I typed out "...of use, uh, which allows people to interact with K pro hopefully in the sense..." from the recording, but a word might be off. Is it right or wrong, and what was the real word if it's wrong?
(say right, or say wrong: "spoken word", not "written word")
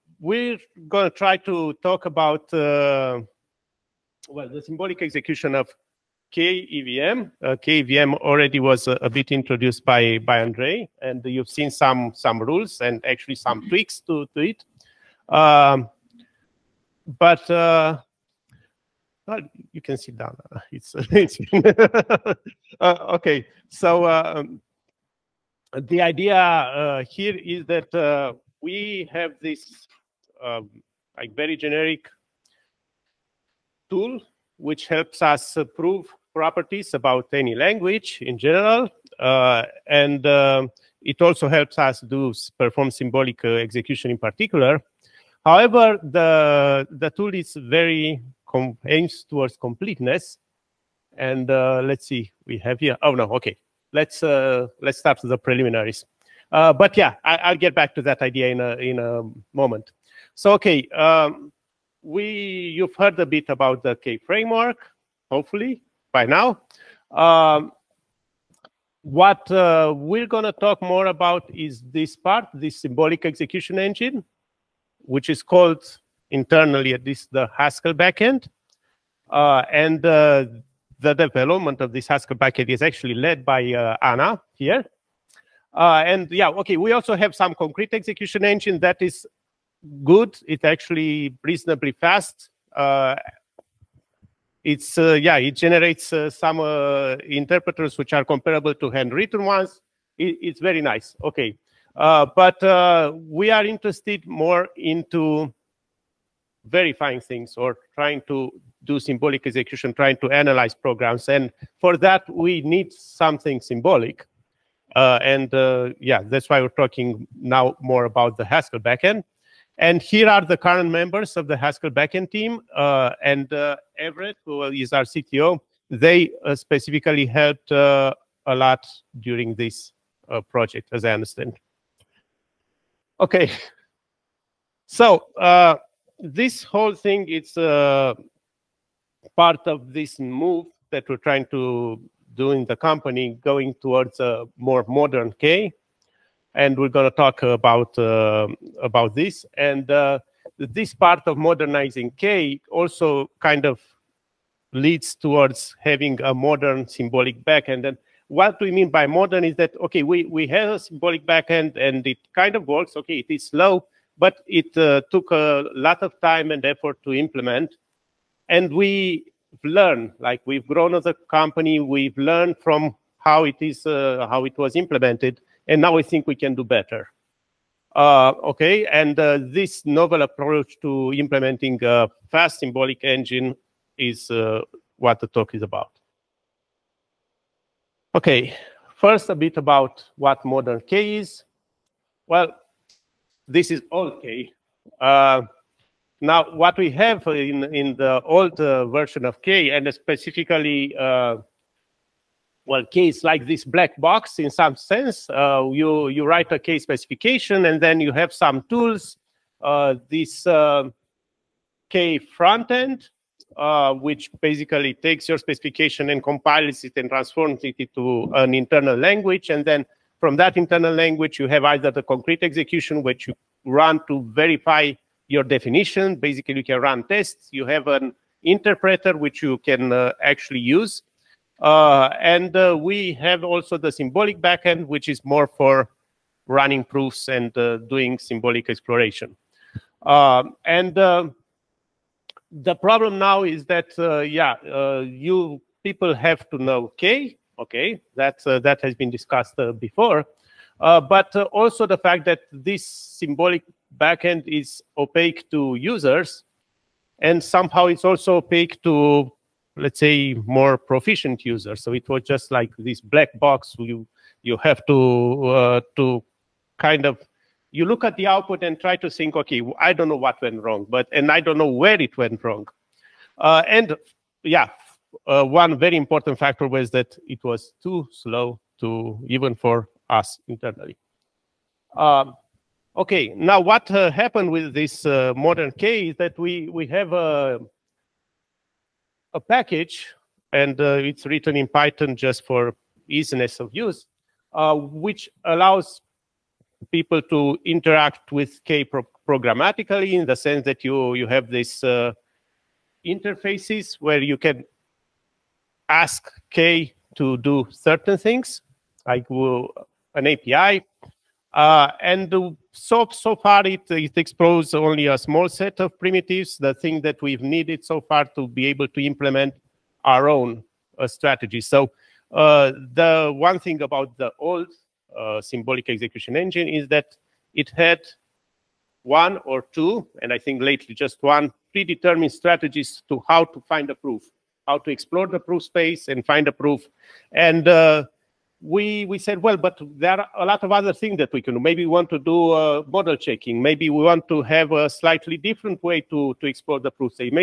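wrong: "programmatically", not "hopefully".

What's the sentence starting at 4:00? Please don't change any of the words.
Um, and uh, the problem now is that, uh, yeah, you people have to know K.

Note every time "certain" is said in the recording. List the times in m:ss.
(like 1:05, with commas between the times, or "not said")
5:07.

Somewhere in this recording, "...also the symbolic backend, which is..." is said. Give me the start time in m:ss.
3:53.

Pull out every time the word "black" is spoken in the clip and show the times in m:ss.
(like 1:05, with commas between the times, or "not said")
3:23, 4:22.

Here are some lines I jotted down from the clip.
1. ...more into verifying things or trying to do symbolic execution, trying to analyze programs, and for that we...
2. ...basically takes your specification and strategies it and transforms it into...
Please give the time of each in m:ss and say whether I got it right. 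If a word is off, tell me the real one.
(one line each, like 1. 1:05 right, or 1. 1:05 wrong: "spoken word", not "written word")
1. 1:44 right
2. 3:34 wrong: "compiles", not "strategies".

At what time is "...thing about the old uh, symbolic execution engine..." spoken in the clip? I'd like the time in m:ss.
5:23.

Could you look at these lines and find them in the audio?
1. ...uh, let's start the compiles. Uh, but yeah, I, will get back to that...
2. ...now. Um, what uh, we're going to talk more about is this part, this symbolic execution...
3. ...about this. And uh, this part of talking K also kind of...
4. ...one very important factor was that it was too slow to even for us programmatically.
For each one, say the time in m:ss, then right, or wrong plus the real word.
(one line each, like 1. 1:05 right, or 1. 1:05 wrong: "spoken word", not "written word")
1. 0:54 wrong: "preliminaries", not "compiles"
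2. 1:06 right
3. 2:28 wrong: "modernizing", not "talking"
4. 4:35 wrong: "internally", not "programmatically".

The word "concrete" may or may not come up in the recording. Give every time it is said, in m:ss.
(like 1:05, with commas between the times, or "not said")
1:27, 3:42.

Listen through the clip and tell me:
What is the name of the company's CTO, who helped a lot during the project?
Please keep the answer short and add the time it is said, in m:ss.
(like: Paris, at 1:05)
Everett, at 2:03.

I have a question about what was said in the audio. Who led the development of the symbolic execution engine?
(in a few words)
Ana.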